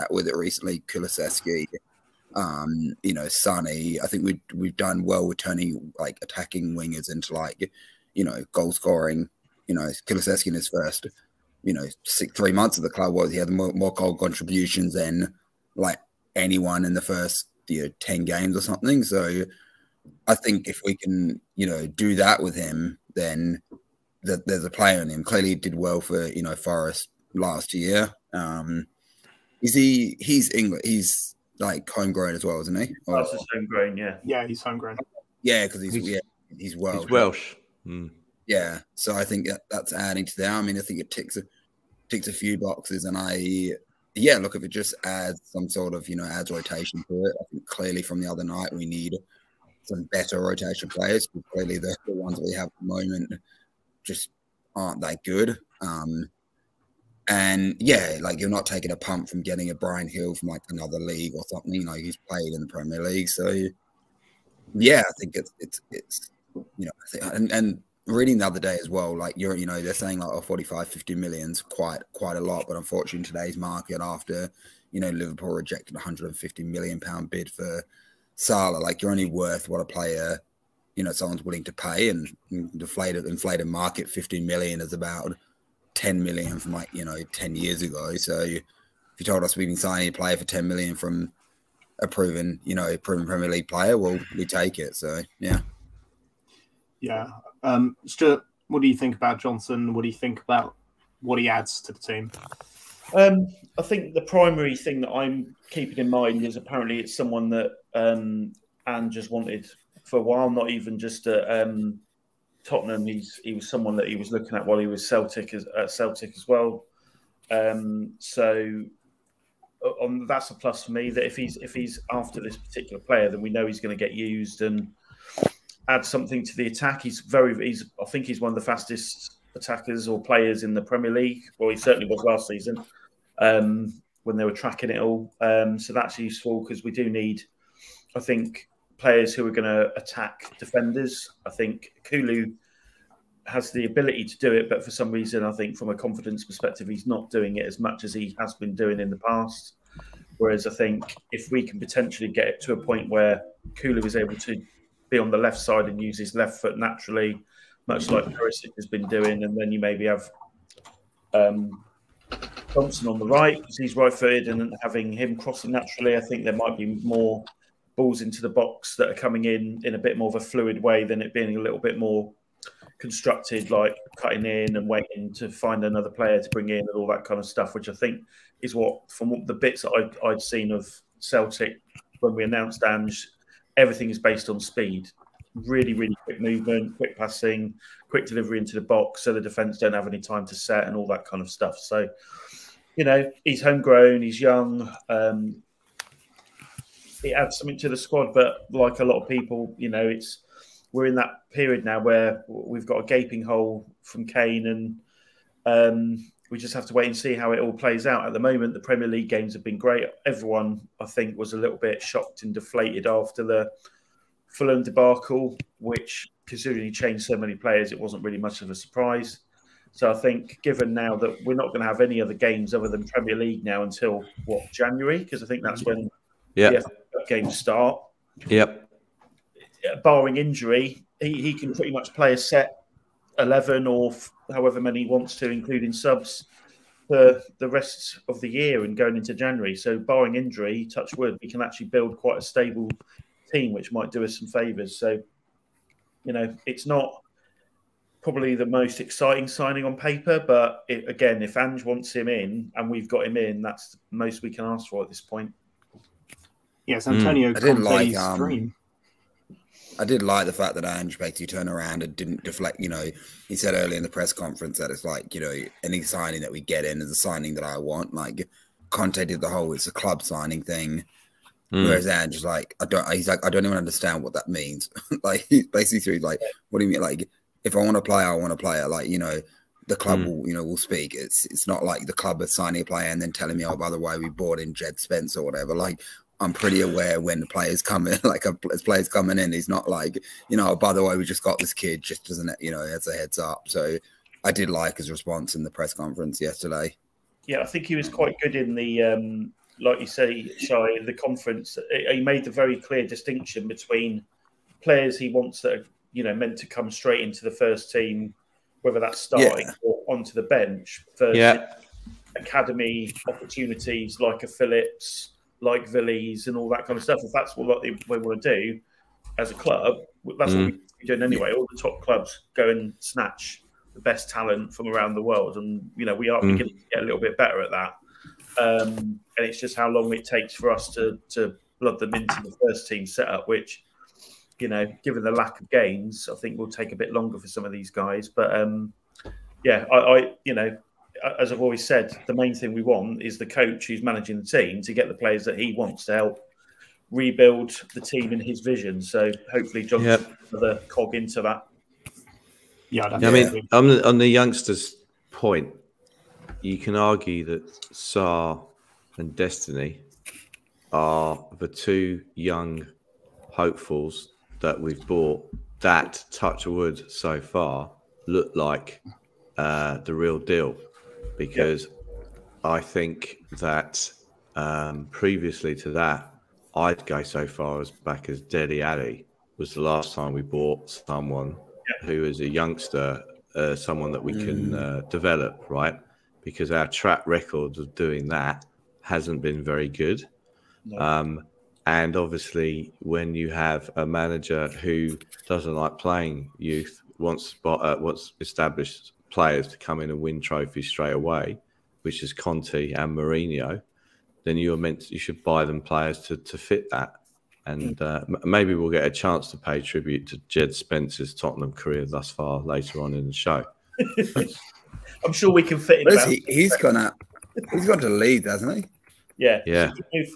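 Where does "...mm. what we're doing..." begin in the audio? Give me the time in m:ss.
5:20.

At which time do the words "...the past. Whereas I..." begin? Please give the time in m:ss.
2:29.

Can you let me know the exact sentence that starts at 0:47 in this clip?
I think clearly from the other night we need some better rotation players.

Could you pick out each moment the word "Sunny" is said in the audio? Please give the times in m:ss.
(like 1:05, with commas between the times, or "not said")
0:03.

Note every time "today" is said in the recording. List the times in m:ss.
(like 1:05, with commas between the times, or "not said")
1:13.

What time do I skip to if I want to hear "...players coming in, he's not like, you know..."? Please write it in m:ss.
4:48.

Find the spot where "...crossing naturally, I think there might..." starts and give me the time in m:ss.
2:45.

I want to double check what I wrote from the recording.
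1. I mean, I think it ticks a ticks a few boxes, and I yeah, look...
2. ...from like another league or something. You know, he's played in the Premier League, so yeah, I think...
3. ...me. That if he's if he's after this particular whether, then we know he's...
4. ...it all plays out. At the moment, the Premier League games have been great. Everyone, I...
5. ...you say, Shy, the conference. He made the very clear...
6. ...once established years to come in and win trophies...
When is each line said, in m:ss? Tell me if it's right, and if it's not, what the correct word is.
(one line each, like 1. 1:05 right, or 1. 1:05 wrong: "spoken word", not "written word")
1. 0:40 right
2. 1:00 right
3. 2:00 wrong: "player", not "whether"
4. 3:27 right
5. 5:00 right
6. 6:37 wrong: "players", not "years".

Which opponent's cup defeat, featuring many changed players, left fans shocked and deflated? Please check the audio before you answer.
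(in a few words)
Fulham.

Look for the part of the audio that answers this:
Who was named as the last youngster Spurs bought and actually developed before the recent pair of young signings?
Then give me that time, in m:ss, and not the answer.
6:18.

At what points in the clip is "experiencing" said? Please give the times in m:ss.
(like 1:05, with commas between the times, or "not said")
not said.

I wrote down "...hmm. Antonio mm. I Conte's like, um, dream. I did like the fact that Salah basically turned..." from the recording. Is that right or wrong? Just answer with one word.
wrong.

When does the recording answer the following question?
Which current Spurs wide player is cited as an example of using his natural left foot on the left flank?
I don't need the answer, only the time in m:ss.
2:38.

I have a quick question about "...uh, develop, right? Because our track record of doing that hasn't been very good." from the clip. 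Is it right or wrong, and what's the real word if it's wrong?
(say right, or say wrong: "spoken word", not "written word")
right.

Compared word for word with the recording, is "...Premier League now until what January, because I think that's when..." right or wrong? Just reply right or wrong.
right.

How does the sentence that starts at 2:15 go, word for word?
Um, so that's useful because we do need, I think, players who are going to attack defenders.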